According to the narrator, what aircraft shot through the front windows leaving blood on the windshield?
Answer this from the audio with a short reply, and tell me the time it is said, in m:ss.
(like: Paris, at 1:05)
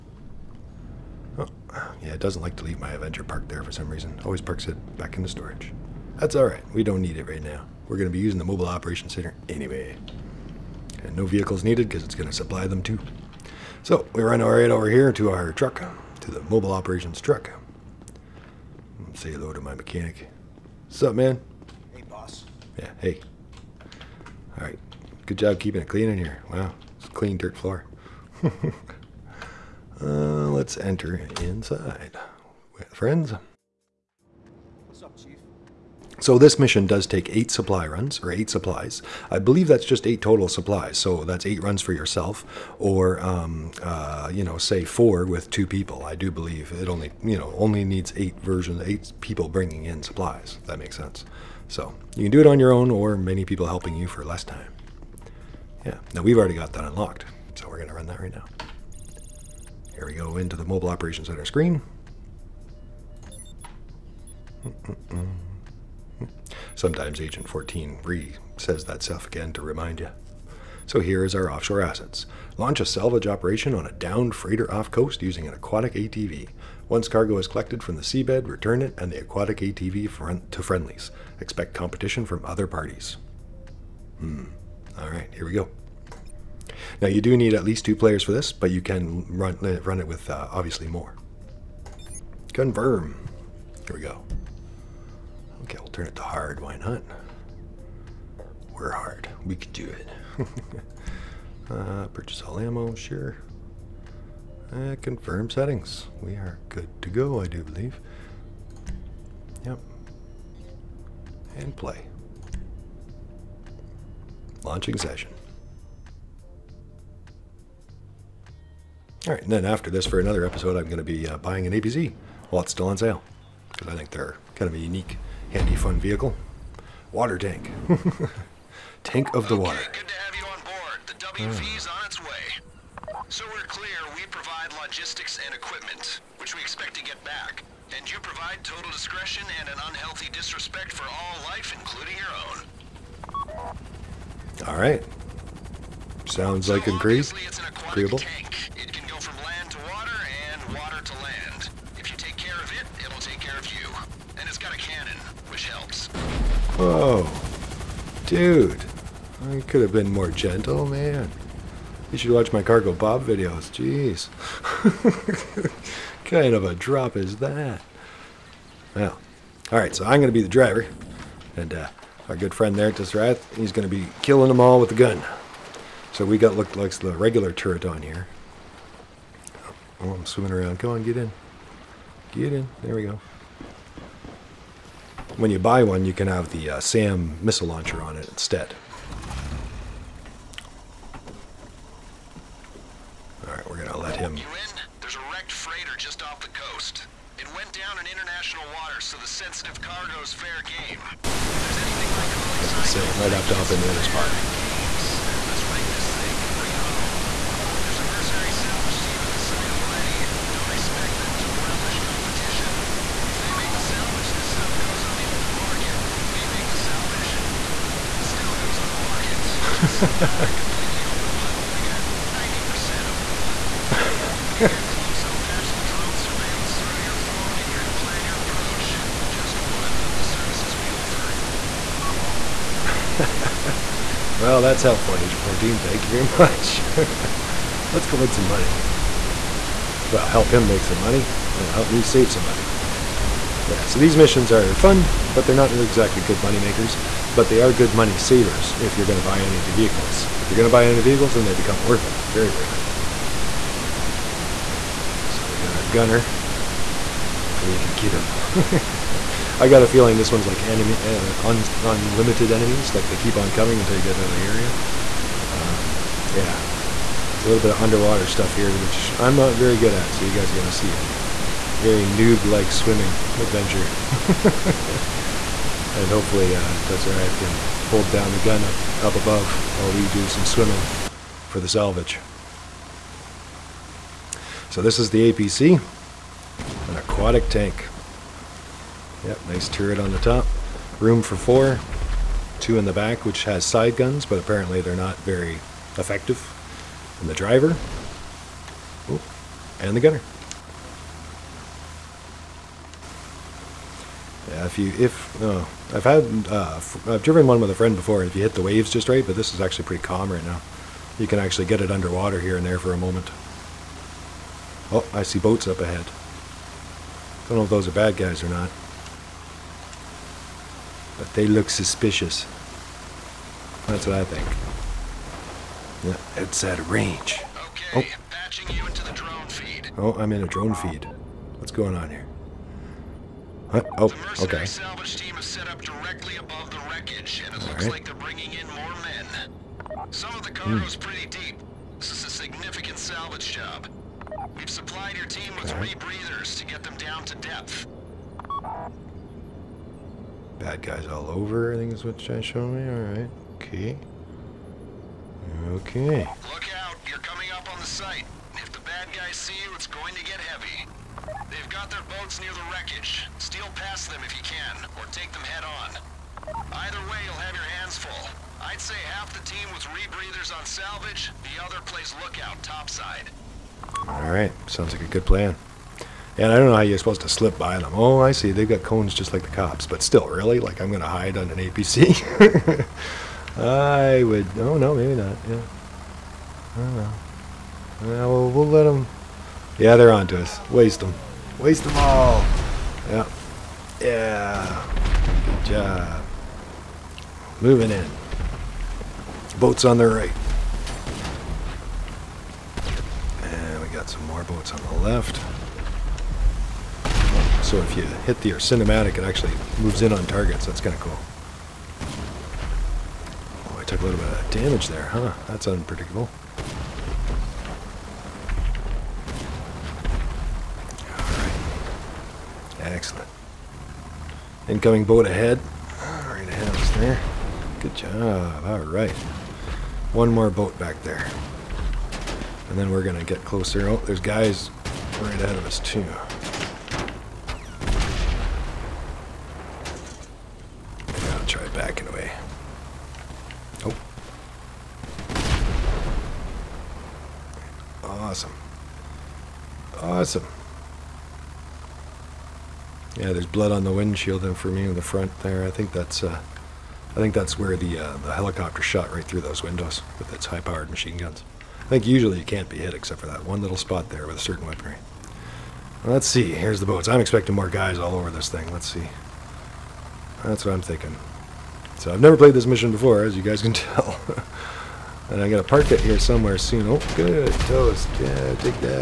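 helicopter, at 7:38.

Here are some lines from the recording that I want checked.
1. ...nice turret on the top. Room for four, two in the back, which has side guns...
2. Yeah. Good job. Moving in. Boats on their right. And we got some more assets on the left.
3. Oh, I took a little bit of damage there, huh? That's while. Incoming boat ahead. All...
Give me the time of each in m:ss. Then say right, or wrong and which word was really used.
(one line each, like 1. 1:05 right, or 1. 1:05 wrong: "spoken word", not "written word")
1. 4:49 right
2. 6:34 wrong: "boats", not "assets"
3. 6:53 wrong: "unpredictable", not "while".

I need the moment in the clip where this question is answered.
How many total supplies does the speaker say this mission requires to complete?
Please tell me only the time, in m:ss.
0:38.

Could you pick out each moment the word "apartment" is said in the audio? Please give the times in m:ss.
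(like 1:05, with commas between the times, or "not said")
not said.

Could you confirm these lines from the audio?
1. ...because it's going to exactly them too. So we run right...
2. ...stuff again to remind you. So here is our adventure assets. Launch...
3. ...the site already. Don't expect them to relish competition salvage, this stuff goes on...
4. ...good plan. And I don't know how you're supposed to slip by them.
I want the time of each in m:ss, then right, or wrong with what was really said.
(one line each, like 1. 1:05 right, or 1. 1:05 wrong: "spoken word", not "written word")
1. 0:11 wrong: "supply", not "exactly"
2. 1:09 wrong: "offshore", not "adventure"
3. 3:29 right
4. 6:15 right.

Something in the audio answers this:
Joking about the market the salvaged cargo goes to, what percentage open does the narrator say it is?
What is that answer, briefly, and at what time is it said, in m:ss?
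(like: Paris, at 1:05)
90%, at 3:42.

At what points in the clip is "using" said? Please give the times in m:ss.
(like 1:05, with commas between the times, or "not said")
0:08, 1:15.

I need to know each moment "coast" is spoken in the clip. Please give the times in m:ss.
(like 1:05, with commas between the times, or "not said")
1:14, 3:16.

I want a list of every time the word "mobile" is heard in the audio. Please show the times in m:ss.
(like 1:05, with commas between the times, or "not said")
0:08, 0:16, 1:00.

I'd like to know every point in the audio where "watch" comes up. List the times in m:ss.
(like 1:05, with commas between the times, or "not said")
2:42.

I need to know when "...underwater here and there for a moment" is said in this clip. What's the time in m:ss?
5:11.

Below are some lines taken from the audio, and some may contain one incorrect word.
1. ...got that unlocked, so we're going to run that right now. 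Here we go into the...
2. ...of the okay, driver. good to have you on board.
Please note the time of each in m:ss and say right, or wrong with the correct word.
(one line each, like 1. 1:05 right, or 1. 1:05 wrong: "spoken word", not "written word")
1. 0:56 right
2. 2:09 wrong: "water", not "driver".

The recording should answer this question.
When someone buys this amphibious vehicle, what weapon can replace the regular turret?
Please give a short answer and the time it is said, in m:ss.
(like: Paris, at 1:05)
SAM missile launcher, at 3:06.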